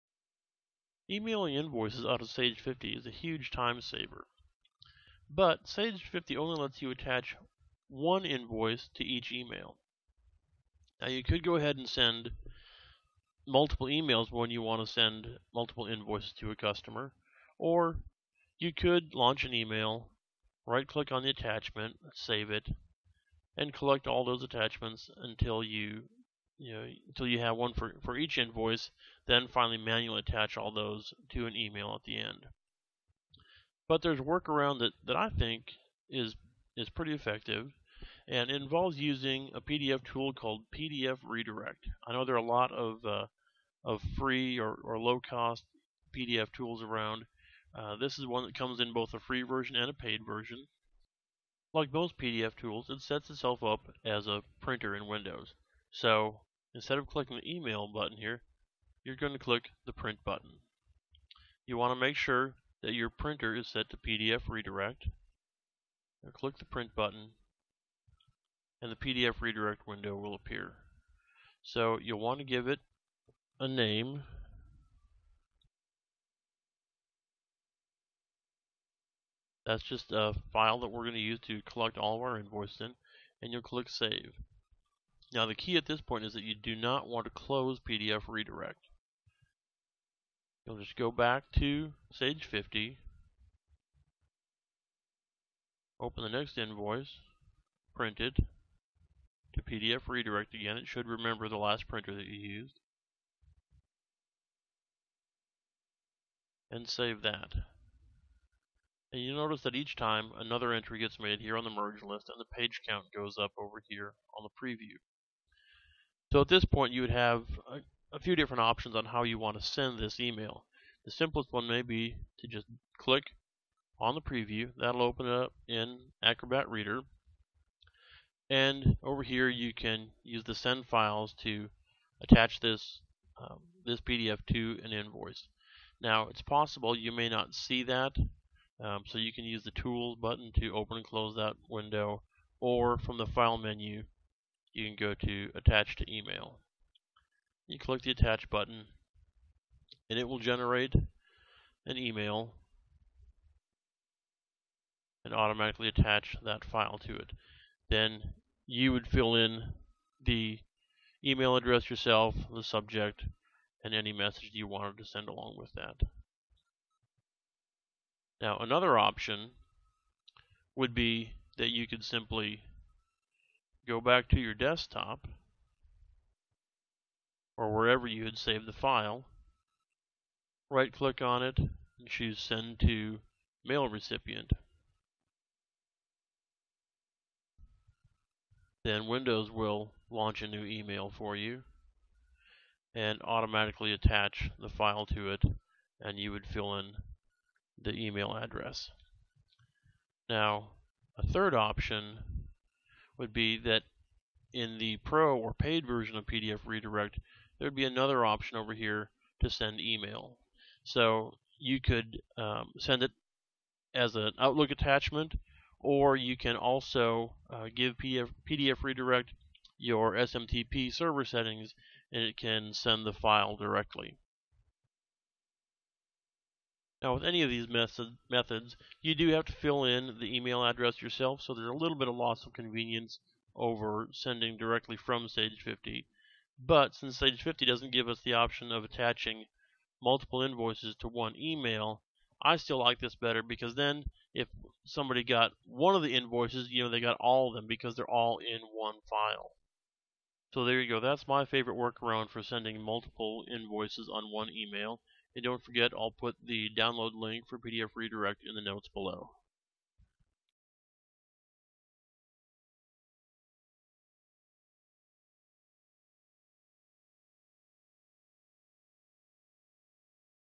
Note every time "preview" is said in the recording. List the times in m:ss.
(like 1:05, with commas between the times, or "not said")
1:54, 2:04.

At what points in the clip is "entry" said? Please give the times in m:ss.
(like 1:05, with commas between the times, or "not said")
1:50.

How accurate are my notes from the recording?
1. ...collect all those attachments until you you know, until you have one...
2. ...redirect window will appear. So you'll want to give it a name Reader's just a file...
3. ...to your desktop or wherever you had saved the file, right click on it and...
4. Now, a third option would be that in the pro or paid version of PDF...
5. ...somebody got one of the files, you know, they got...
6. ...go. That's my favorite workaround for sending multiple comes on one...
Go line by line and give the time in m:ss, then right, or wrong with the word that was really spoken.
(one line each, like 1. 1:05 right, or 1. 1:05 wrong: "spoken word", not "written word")
1. 0:23 right
2. 1:09 wrong: "That", not "Reader"
3. 2:54 right
4. 3:20 right
5. 4:04 wrong: "invoices", not "files"
6. 4:10 wrong: "invoices", not "comes".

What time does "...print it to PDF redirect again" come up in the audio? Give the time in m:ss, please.
1:37.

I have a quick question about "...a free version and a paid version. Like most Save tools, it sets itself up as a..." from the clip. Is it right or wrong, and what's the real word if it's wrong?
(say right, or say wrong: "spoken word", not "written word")
wrong: "PDF", not "Save".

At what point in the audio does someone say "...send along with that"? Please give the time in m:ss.
2:45.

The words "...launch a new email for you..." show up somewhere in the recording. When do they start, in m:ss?
3:10.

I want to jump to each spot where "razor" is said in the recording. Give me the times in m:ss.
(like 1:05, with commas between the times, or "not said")
not said.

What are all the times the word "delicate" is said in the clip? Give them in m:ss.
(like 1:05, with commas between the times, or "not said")
not said.